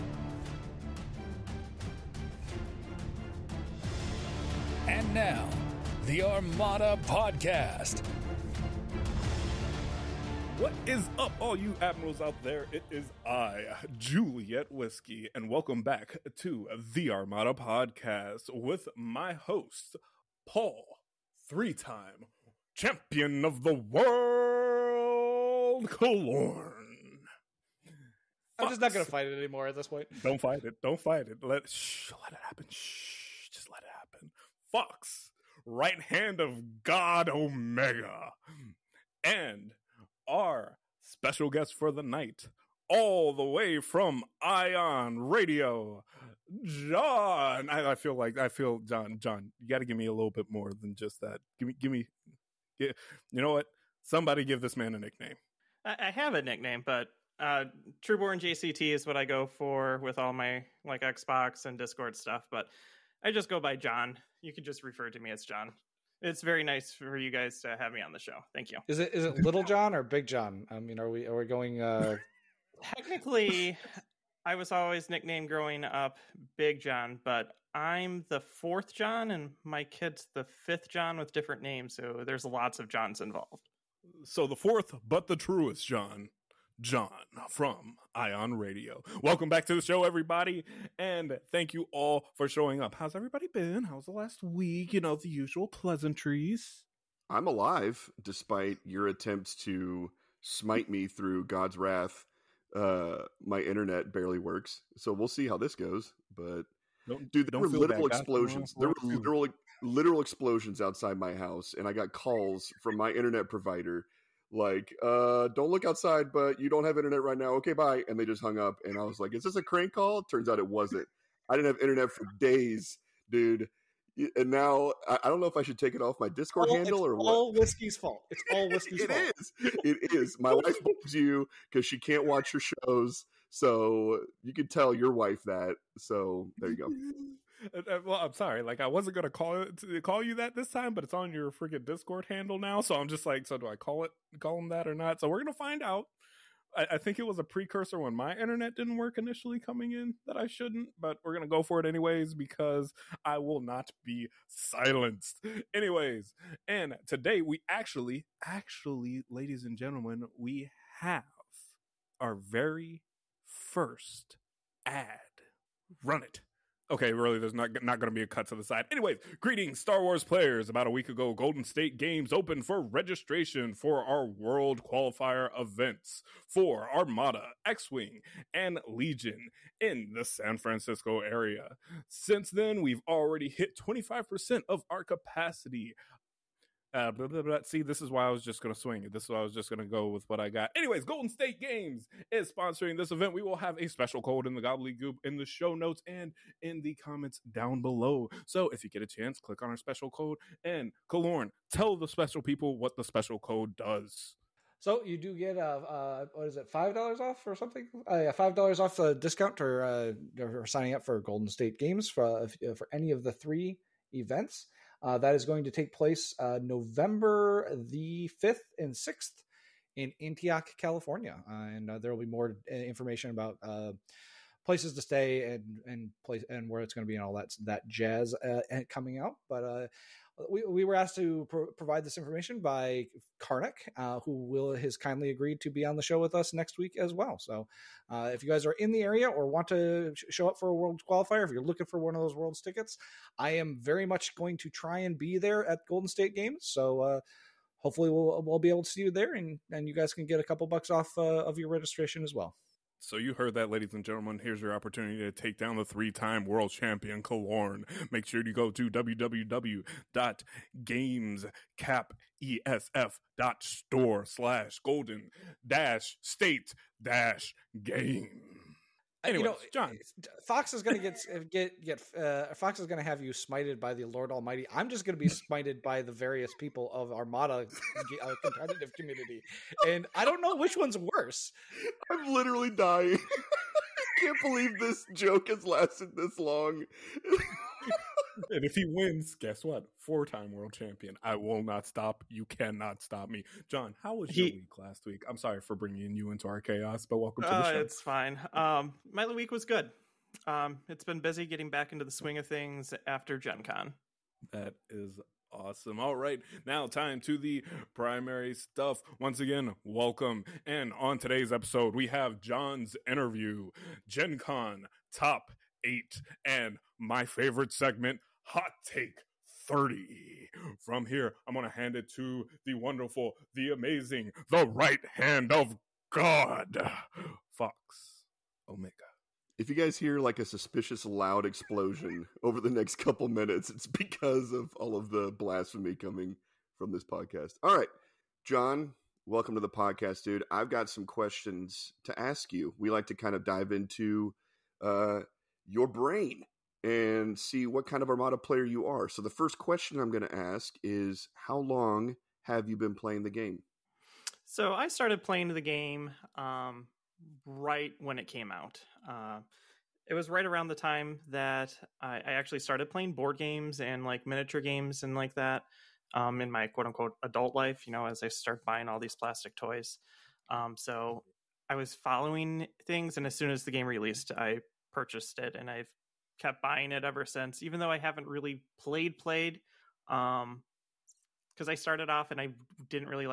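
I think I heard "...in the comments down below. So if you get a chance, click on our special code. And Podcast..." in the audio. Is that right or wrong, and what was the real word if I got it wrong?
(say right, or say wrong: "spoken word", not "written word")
wrong: "Kelorn", not "Podcast".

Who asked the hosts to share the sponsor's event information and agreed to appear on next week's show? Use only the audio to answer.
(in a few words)
Karnak.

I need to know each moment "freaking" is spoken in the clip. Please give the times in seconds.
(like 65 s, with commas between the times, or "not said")
141 s.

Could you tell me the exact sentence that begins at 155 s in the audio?
Anyways, and today we actually, actually, ladies and gentlemen, we have our very first ad.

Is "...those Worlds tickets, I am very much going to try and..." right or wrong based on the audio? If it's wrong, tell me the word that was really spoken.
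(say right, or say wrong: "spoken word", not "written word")
right.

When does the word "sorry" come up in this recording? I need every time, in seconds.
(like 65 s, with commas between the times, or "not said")
138 s, 295 s.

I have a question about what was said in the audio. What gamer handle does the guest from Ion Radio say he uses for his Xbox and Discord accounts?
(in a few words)
Trueborn JCT.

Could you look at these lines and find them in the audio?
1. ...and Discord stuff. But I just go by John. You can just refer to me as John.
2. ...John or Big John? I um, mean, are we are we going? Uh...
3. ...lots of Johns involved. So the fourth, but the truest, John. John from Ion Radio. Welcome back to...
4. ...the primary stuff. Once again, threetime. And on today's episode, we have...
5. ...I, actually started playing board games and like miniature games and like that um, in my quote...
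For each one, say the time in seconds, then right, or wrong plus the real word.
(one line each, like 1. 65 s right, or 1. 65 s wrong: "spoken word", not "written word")
1. 61 s right
2. 69 s right
3. 82 s right
4. 307 s wrong: "welcome", not "threetime"
5. 362 s right.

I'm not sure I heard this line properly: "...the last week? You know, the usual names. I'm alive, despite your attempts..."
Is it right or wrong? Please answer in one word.
wrong.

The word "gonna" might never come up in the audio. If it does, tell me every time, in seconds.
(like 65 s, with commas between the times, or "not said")
28 s, 139 s, 145 s, 151 s.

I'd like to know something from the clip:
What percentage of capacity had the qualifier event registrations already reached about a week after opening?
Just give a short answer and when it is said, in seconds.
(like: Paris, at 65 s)
25%, at 183 s.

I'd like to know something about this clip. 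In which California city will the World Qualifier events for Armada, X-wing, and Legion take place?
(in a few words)
Antioch.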